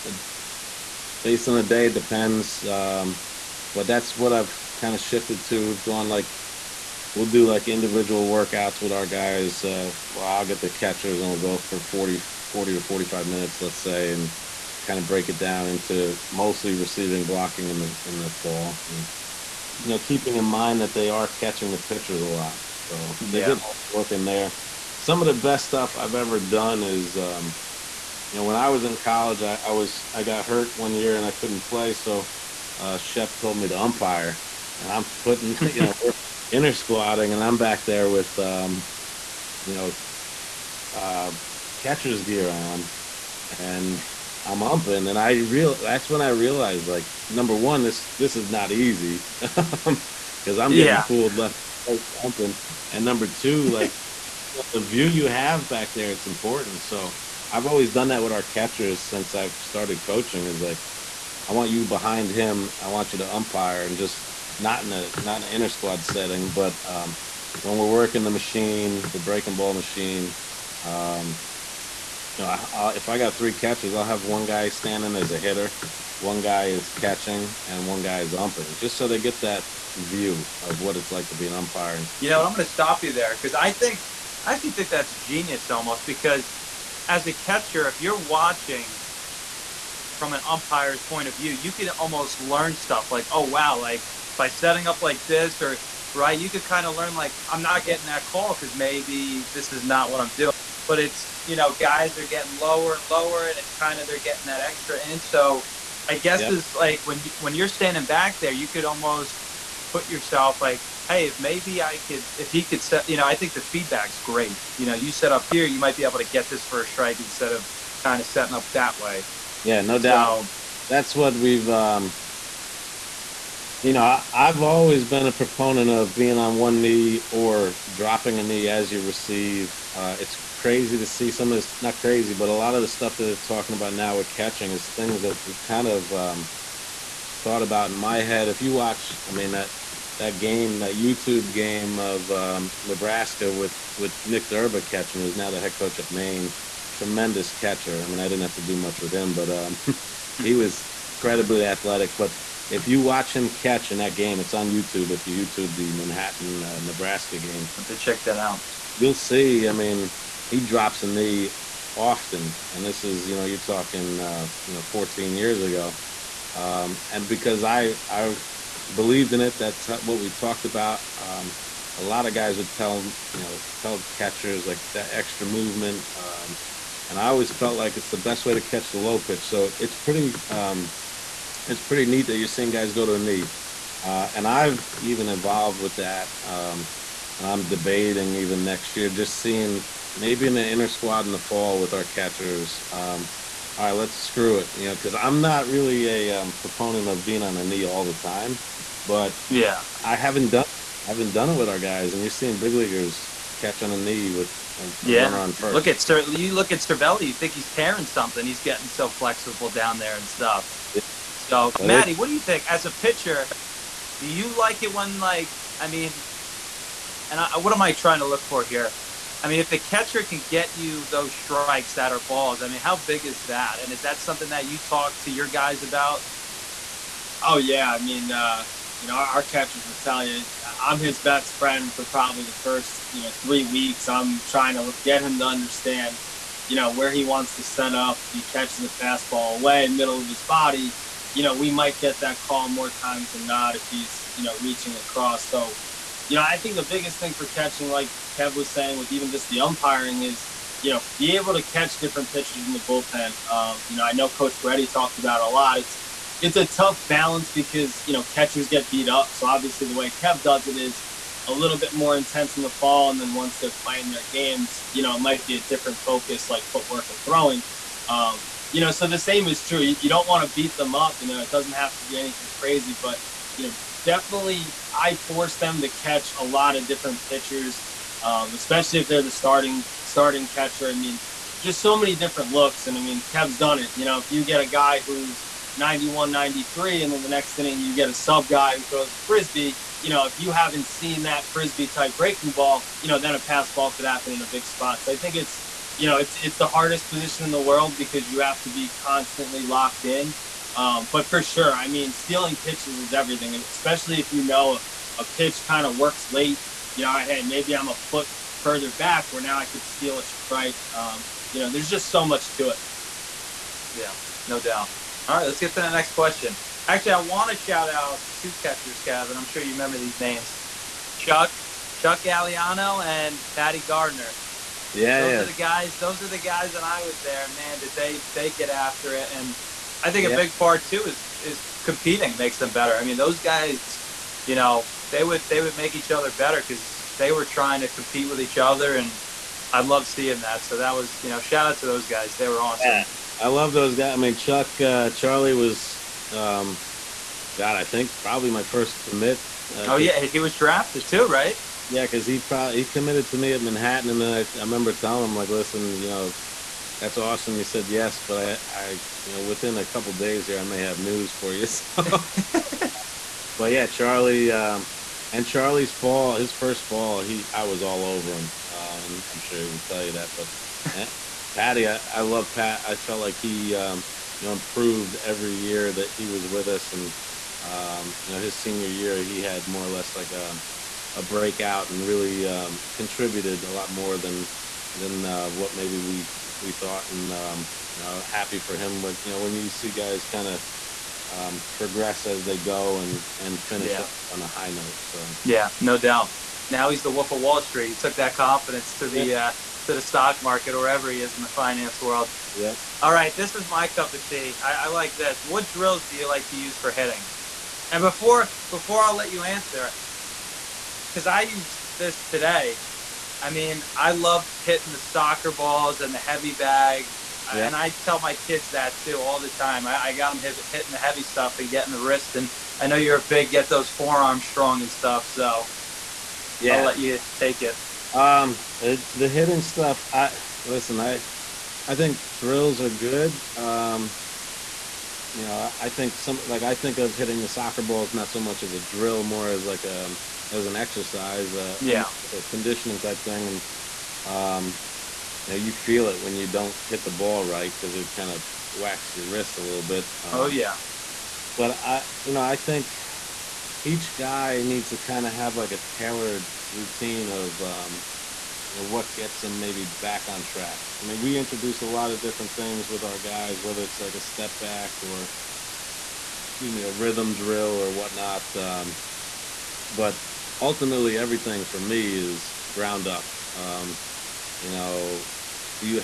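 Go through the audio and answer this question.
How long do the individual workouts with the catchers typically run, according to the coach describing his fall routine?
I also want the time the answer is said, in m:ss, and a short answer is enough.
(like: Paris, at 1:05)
40 to 45 minutes, at 0:12.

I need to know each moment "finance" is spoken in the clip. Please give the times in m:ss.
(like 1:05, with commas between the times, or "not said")
6:41.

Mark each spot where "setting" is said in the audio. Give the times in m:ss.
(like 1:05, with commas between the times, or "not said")
1:06, 1:34, 1:58.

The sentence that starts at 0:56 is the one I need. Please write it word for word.
So I've always done that with our catchers since I've started coaching.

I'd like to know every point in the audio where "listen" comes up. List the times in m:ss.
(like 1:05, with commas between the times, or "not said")
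5:55, 7:10.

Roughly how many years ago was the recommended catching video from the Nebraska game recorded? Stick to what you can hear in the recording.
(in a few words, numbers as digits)
14 years.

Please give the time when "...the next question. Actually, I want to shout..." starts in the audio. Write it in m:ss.
5:15.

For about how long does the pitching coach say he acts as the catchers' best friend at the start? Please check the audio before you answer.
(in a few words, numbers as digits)
3 weeks.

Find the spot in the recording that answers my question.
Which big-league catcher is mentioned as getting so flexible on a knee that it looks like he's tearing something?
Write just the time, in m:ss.
3:26.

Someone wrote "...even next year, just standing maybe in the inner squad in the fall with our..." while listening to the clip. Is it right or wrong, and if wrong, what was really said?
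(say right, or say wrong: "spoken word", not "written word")
wrong: "seeing", not "standing".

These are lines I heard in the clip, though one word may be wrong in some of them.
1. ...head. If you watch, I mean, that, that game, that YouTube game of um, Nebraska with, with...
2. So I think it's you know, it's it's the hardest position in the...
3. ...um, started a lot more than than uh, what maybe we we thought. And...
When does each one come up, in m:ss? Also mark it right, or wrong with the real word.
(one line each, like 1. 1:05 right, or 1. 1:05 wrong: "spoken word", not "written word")
1. 2:18 right
2. 4:55 right
3. 6:22 wrong: "contributed", not "started".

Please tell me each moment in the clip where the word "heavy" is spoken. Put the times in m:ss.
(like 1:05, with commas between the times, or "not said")
6:56, 7:00.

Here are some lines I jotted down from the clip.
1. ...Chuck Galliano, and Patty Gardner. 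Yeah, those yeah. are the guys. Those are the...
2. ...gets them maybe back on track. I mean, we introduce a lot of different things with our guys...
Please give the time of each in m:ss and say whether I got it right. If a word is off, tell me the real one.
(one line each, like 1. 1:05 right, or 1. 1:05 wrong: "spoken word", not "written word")
1. 5:21 right
2. 7:39 right.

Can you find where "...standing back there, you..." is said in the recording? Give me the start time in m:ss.
1:47.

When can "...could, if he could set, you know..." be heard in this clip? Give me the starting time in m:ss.
1:52.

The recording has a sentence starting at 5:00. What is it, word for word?
Um, but for sure, I mean, stealing pitches is everything, especially if you know a pitch kind of works late.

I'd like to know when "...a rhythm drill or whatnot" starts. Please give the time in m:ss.
7:46.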